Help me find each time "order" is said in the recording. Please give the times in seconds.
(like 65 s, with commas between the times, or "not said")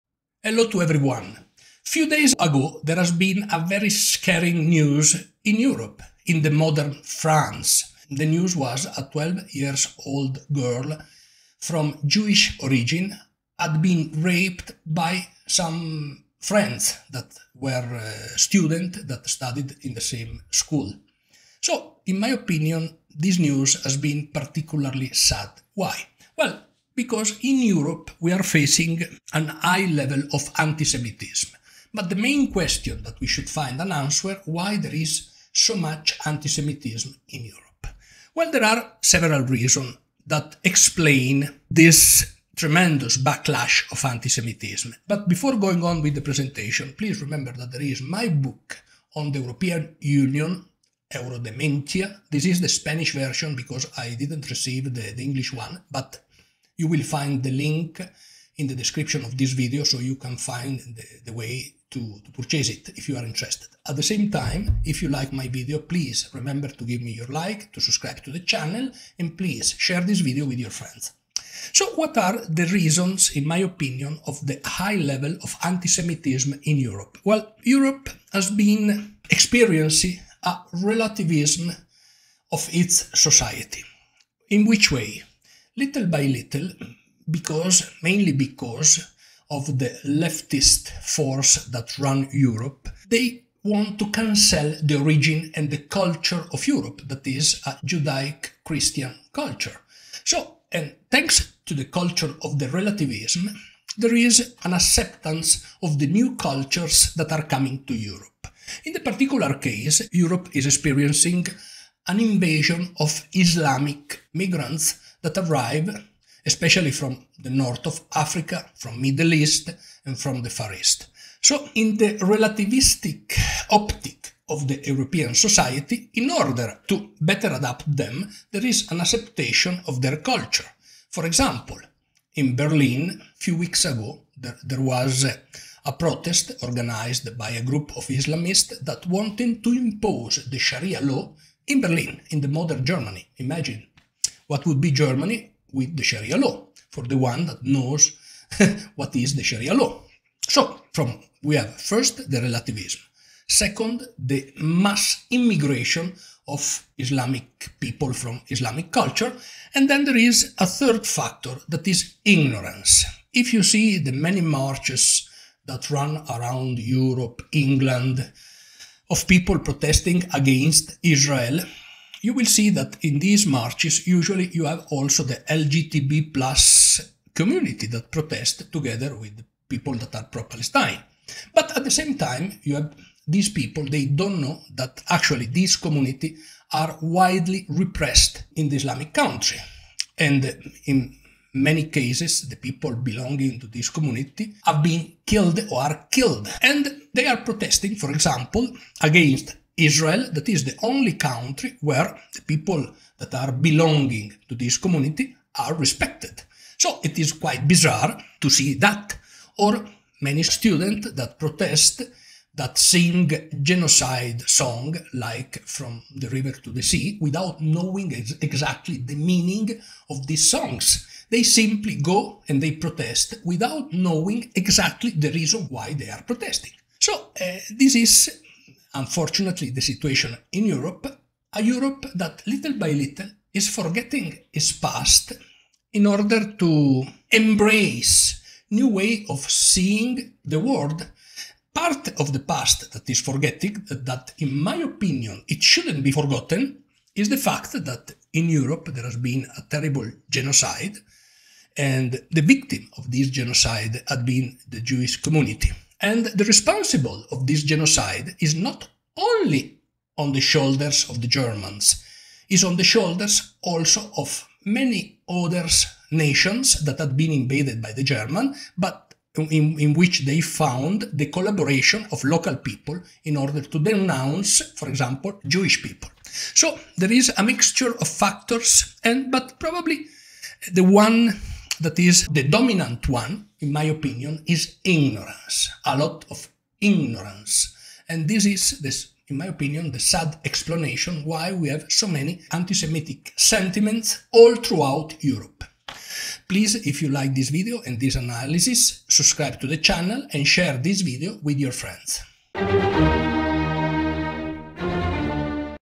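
126 s, 236 s, 273 s.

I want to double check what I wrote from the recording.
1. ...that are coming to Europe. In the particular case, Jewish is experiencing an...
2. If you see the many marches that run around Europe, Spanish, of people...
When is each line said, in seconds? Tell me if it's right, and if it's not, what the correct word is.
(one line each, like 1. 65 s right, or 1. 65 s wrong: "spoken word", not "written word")
1. 107 s wrong: "Europe", not "Jewish"
2. 163 s wrong: "England", not "Spanish".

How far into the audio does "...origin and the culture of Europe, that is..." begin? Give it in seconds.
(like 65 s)
94 s.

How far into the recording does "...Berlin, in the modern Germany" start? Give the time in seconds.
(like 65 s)
141 s.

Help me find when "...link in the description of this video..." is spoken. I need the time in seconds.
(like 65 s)
57 s.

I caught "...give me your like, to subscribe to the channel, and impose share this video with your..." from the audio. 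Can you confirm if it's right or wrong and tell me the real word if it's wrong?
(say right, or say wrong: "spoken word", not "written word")
wrong: "please", not "impose".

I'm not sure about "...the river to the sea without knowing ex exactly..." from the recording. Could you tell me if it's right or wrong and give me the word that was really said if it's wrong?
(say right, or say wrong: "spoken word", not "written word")
right.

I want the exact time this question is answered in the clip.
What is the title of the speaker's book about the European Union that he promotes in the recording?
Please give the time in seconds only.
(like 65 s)
51 s.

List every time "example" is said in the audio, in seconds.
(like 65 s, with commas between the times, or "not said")
131 s, 198 s, 274 s.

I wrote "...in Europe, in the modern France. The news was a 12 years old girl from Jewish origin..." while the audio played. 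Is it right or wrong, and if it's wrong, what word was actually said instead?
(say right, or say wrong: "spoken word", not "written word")
right.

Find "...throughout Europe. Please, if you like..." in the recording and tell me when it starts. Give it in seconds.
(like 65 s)
294 s.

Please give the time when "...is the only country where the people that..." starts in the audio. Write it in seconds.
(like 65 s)
200 s.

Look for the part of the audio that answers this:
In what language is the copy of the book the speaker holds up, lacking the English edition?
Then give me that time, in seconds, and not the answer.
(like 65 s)
52 s.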